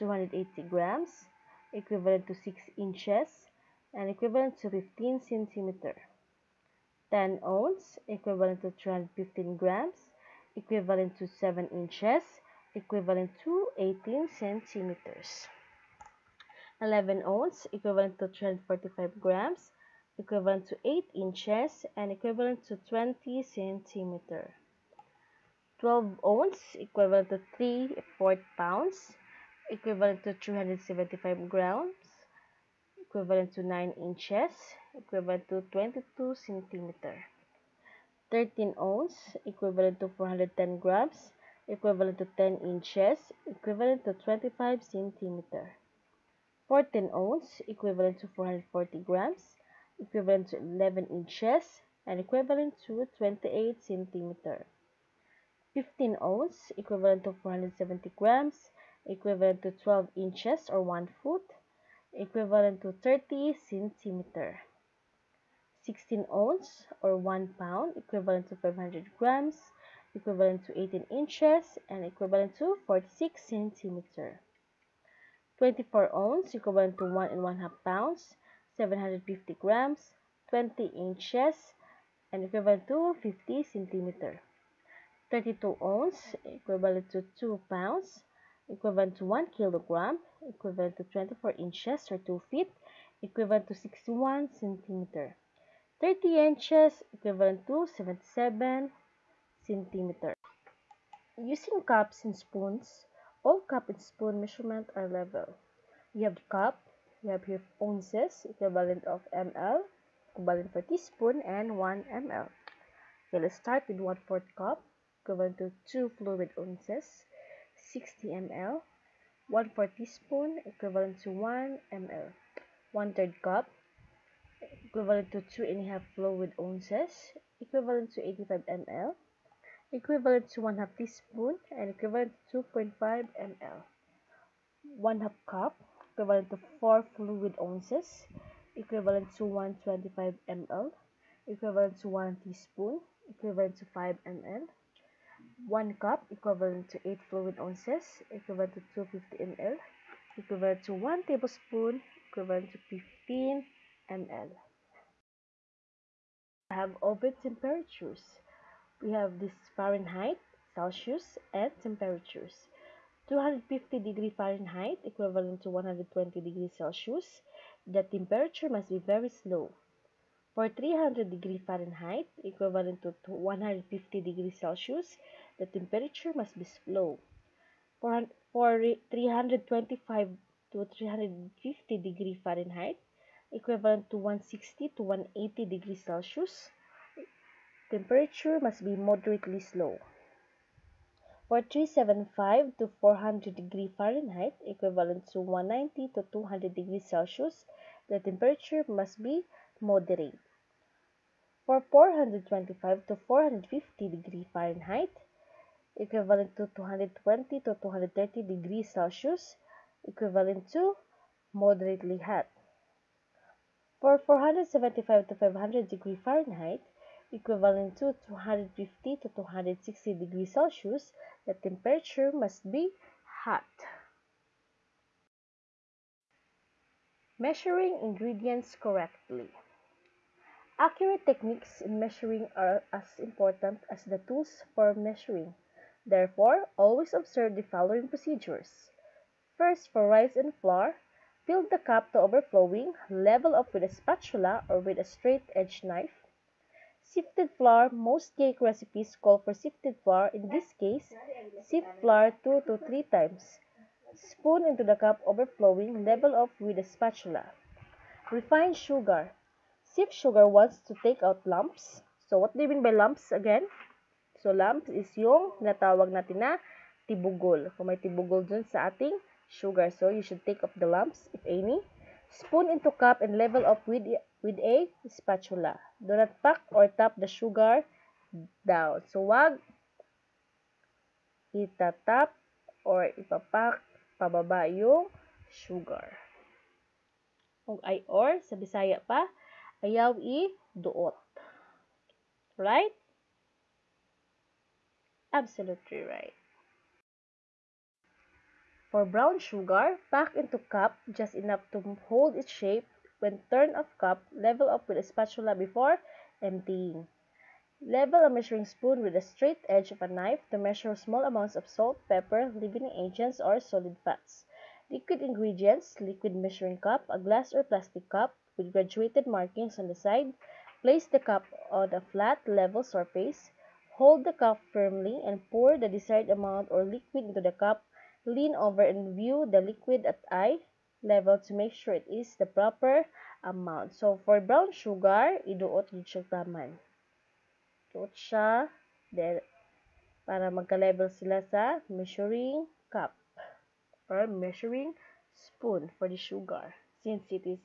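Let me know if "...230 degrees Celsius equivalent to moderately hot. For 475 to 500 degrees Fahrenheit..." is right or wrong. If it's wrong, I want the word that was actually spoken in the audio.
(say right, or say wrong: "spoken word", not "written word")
right.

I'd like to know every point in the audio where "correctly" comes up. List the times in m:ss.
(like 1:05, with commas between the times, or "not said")
3:48.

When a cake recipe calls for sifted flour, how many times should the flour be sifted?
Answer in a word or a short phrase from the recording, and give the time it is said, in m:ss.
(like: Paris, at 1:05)
2 to 3 times, at 4:12.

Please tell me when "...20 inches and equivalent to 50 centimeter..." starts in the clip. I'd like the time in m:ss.
1:20.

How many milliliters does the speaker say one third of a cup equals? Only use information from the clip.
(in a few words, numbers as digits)
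85 ml.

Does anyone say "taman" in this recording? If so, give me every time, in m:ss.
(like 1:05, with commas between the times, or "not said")
5:36.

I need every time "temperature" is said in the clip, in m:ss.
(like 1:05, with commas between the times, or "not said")
2:37, 2:41, 2:48, 2:55, 3:07, 3:18, 3:41.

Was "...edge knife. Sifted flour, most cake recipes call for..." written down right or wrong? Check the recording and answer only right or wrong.
right.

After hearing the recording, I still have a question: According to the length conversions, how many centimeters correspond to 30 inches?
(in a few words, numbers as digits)
77 centimeters.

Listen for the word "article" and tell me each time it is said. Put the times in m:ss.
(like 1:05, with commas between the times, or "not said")
not said.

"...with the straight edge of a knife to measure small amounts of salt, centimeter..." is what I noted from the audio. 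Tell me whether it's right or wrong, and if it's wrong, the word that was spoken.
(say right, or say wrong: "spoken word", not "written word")
wrong: "pepper", not "centimeter".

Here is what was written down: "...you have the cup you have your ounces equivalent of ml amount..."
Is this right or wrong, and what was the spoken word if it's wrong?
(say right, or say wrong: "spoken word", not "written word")
wrong: "equivalent", not "amount".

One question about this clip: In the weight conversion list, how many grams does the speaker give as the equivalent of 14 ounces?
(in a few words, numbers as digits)
440 grams.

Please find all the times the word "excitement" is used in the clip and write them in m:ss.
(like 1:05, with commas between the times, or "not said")
not said.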